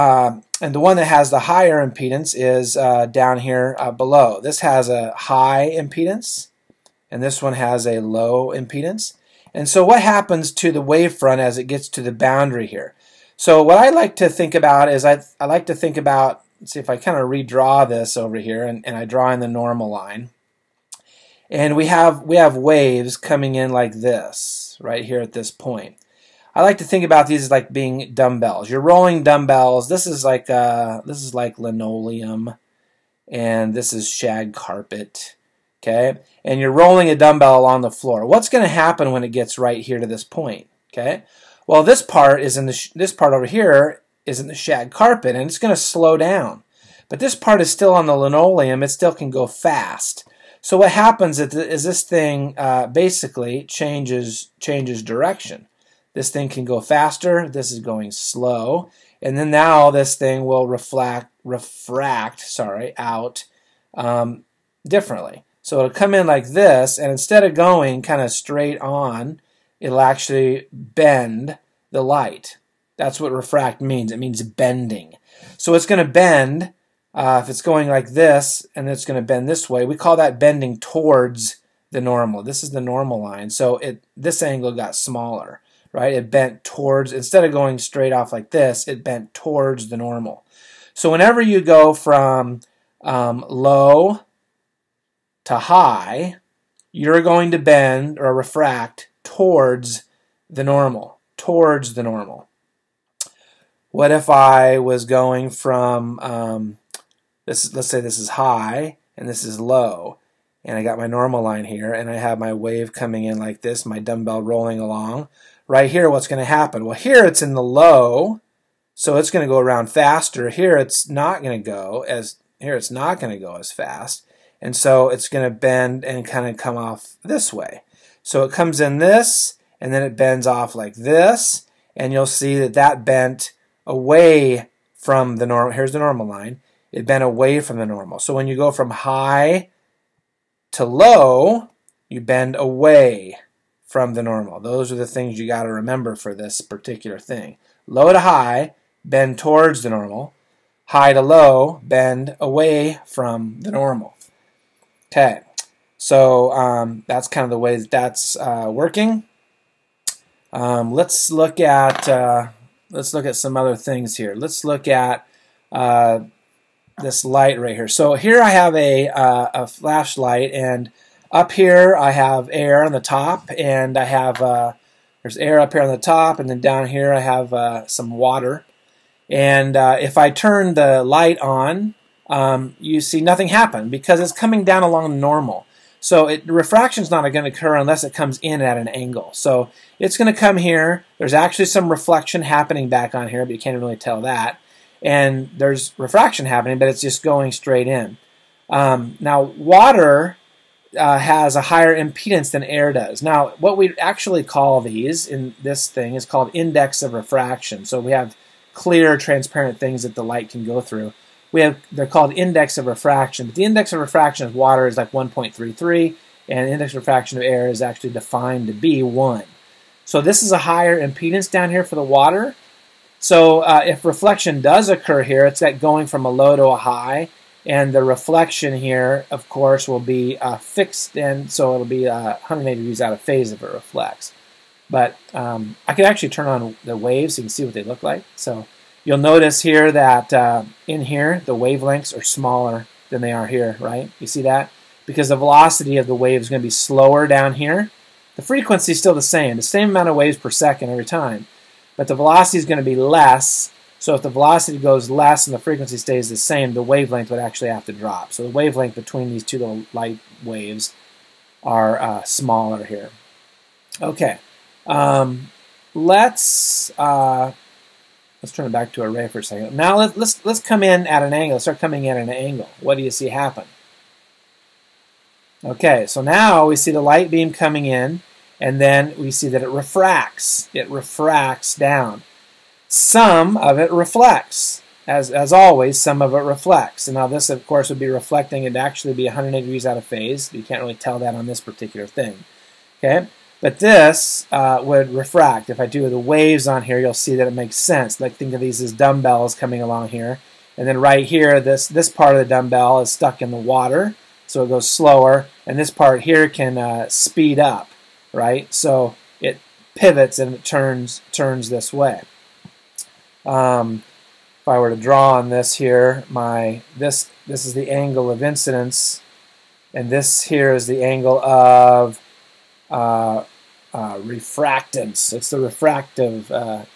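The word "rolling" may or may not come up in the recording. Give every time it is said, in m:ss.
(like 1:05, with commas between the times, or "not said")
0:28, 0:36, 1:54.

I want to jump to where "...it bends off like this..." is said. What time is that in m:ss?
2:10.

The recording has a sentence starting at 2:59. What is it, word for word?
And if I turn the light on, um, you see nothing happen because it's coming down along normal.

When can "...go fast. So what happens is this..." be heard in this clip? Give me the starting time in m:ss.
0:49.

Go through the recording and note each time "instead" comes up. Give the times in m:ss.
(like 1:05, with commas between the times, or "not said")
1:07, 1:27.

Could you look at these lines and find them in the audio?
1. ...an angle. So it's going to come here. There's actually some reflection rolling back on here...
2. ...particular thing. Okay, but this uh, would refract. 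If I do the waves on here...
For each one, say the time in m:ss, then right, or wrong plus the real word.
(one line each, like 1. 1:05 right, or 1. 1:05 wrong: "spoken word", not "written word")
1. 3:08 wrong: "happening", not "rolling"
2. 4:51 right.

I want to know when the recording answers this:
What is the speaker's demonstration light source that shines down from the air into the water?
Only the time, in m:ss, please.
2:49.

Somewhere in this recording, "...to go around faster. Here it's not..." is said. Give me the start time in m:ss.
1:59.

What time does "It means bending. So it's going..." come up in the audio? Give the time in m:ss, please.
1:14.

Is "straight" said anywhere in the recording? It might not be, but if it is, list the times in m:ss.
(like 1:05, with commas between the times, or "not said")
1:08, 1:27, 3:17.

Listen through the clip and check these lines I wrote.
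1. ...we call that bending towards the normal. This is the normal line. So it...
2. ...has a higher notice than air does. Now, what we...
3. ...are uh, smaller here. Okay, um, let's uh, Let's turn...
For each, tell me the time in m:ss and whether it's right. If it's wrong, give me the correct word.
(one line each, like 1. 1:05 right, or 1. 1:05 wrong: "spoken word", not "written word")
1. 1:19 right
2. 3:21 wrong: "impedance", not "notice"
3. 4:21 right.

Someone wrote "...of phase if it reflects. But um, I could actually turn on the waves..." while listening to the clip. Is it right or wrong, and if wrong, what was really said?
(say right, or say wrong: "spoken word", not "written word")
right.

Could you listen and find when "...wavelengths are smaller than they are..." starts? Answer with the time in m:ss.
4:01.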